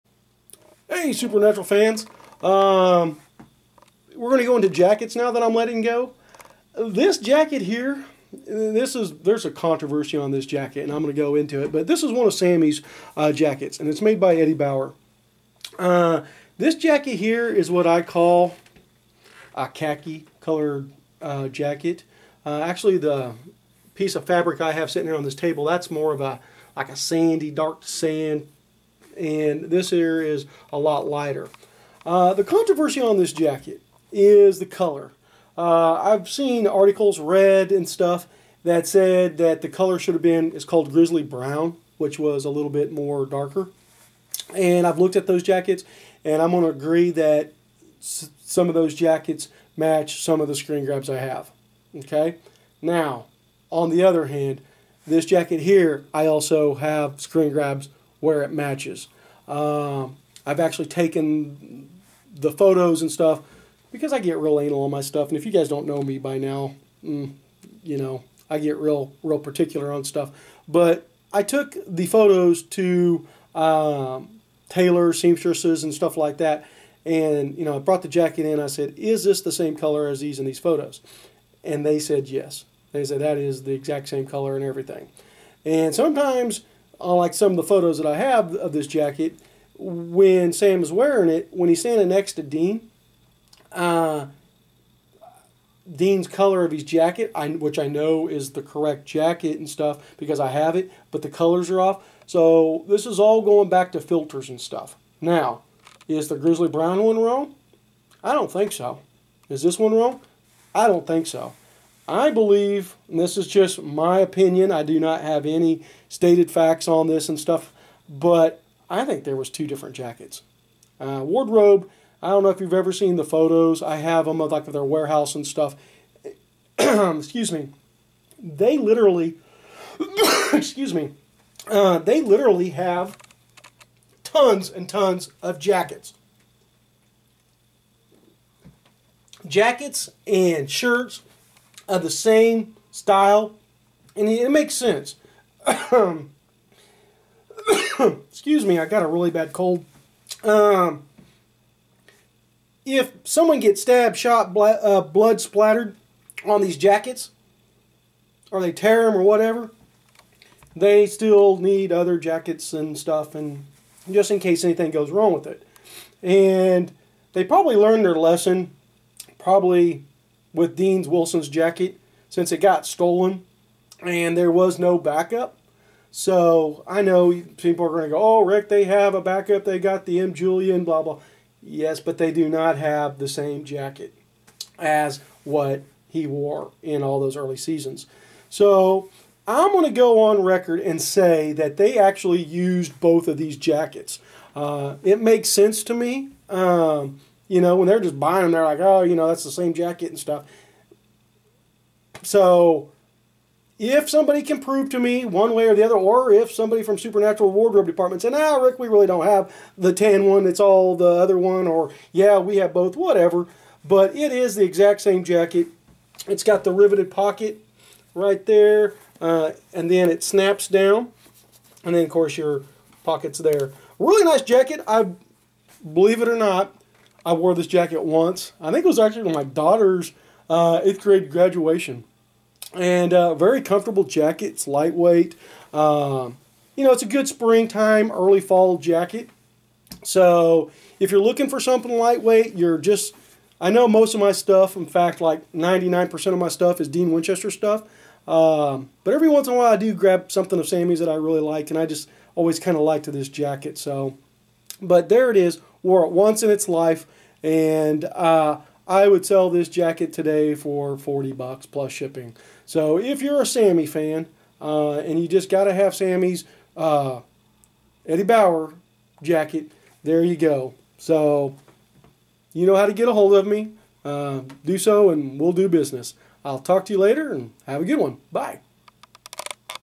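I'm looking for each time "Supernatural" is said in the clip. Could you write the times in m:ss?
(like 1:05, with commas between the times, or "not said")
0:01, 3:26.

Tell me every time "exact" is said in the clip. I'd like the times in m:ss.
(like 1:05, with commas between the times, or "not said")
1:23, 3:34.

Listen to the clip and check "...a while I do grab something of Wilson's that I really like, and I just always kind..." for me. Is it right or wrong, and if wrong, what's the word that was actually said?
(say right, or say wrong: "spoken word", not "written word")
wrong: "Sammy", not "Wilson".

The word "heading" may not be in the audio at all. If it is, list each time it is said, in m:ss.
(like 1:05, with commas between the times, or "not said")
not said.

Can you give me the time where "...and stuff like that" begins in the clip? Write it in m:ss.
1:15.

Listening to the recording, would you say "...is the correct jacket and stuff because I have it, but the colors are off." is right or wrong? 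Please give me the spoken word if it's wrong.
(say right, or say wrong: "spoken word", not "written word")
right.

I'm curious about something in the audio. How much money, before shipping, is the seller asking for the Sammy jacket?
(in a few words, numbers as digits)
$40.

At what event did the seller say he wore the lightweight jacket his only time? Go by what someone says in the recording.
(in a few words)
Eighth grade graduation.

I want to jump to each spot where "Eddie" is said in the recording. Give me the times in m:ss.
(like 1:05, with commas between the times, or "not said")
0:14, 4:28.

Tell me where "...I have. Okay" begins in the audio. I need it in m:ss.
0:51.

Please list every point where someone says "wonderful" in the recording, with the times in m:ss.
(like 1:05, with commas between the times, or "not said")
not said.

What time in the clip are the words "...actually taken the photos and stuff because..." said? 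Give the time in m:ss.
1:00.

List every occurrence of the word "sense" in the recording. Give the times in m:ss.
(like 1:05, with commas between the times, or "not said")
2:24, 3:15.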